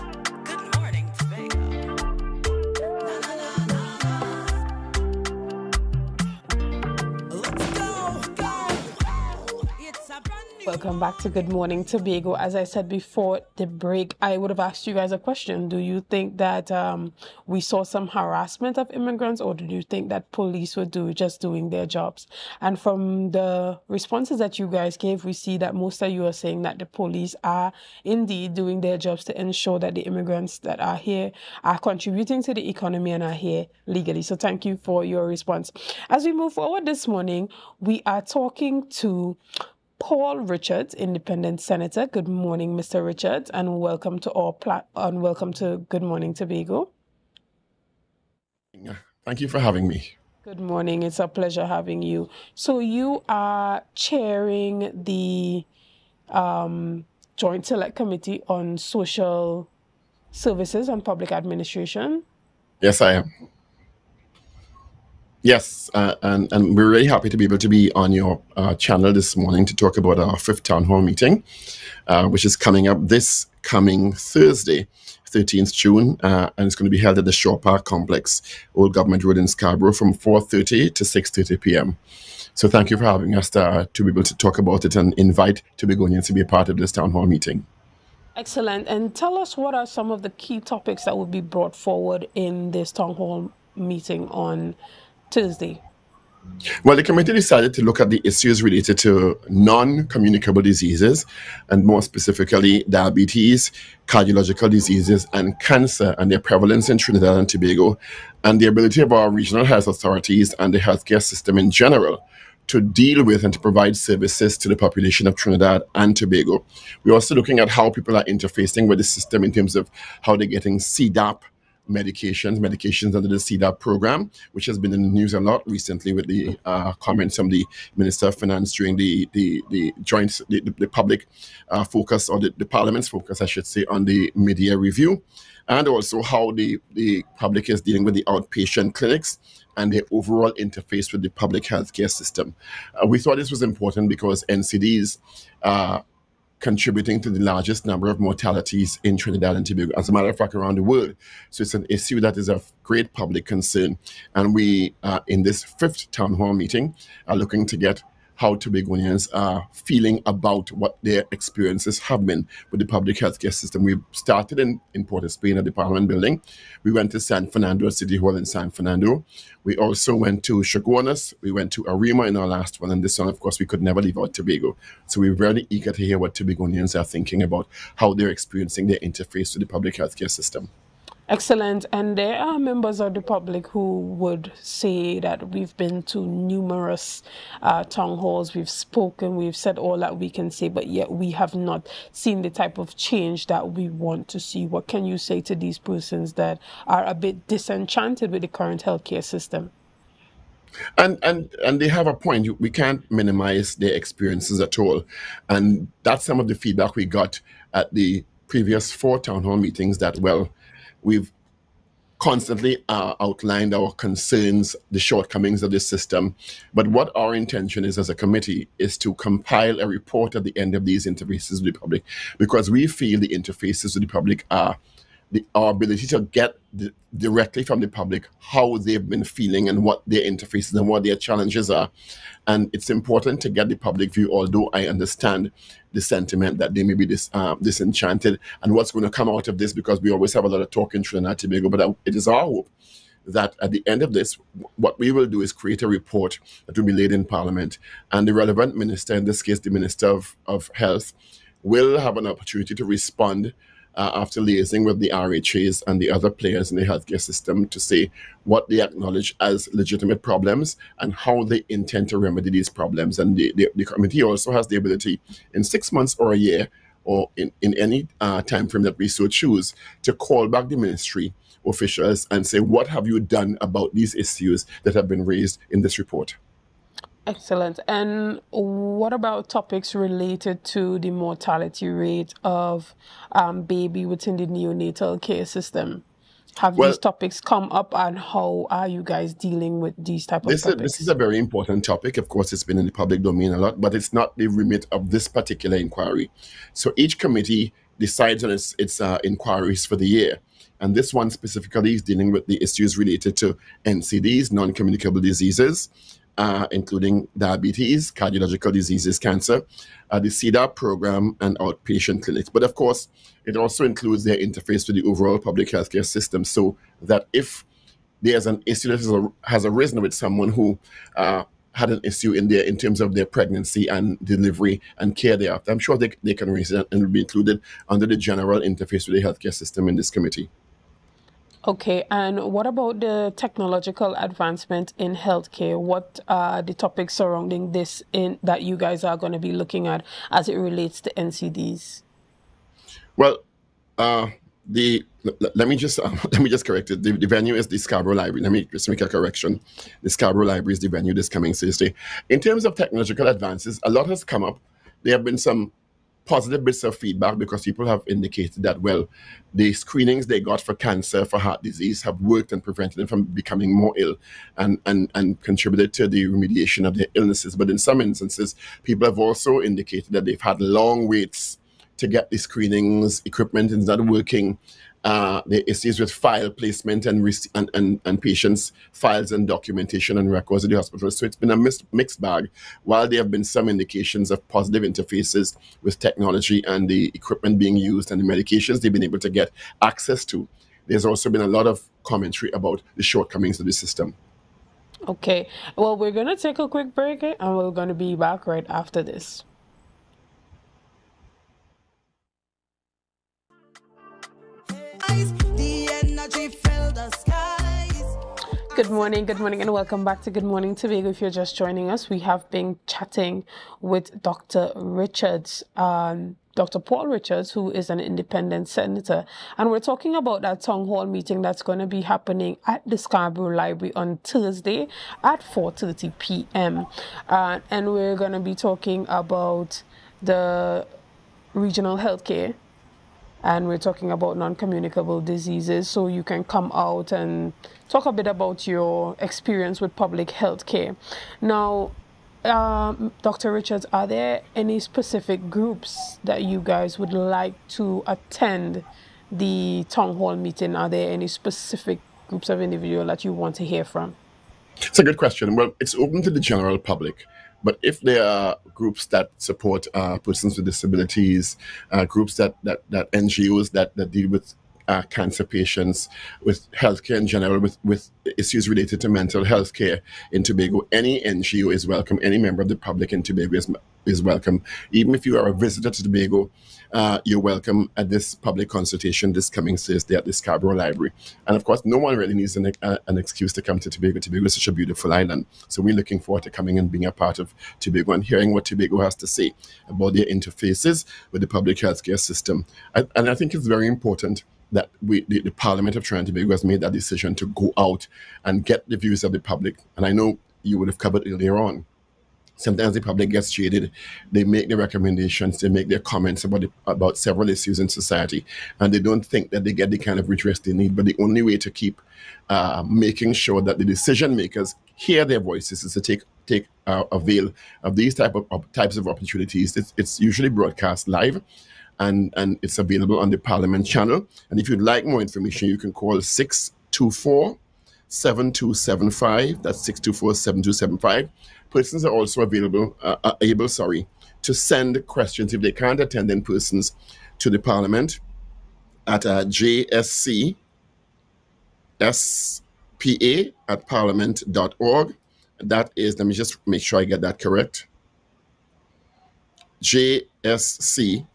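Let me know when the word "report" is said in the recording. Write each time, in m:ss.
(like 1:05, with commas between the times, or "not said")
3:39, 4:05, 4:35.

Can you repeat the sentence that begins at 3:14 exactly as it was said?
What can you say to these persons that are a bit disenchanted with the current healthcare system?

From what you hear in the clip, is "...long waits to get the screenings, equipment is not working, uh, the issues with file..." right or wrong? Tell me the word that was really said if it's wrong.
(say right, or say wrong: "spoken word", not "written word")
right.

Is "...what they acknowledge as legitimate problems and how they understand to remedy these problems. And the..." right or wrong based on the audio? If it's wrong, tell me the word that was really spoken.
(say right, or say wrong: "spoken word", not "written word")
wrong: "intend", not "understand".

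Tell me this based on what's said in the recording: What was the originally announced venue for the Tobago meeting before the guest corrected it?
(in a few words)
Shaw Park Complex.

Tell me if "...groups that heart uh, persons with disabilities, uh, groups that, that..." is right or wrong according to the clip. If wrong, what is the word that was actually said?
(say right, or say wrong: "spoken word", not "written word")
wrong: "support", not "heart".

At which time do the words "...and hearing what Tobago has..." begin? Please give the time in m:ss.
8:08.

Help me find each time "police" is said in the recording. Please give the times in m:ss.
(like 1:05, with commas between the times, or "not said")
0:20, 0:26.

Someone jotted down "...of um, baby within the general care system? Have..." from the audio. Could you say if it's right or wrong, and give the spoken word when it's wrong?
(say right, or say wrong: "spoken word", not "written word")
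wrong: "neonatal", not "general".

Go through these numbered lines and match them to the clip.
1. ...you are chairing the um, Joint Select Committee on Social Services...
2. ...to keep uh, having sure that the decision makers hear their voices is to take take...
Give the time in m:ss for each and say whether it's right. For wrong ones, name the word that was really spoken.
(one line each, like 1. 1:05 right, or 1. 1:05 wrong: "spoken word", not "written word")
1. 0:52 right
2. 8:31 wrong: "making", not "having".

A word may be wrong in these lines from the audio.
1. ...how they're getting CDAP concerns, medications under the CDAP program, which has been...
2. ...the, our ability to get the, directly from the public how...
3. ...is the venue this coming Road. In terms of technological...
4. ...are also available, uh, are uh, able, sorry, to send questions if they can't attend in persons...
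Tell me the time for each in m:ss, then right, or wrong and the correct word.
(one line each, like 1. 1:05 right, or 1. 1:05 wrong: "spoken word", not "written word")
1. 2:00 wrong: "medications", not "concerns"
2. 3:45 right
3. 5:50 wrong: "Thursday", not "Road"
4. 8:52 right.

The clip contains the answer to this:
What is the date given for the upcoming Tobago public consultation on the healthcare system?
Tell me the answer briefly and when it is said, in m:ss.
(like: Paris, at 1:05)
13th June, at 1:15.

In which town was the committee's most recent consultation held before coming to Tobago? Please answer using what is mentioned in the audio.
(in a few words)
Arima.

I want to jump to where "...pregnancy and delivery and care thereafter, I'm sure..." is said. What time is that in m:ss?
5:23.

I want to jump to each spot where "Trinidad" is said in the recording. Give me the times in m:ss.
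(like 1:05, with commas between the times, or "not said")
1:46, 1:55, 2:29, 4:01, 8:16.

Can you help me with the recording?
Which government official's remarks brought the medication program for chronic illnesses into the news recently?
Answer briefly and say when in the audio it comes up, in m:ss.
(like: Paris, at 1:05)
Minister of Finance, at 2:07.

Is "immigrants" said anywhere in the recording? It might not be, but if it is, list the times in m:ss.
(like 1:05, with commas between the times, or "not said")
0:18, 0:30.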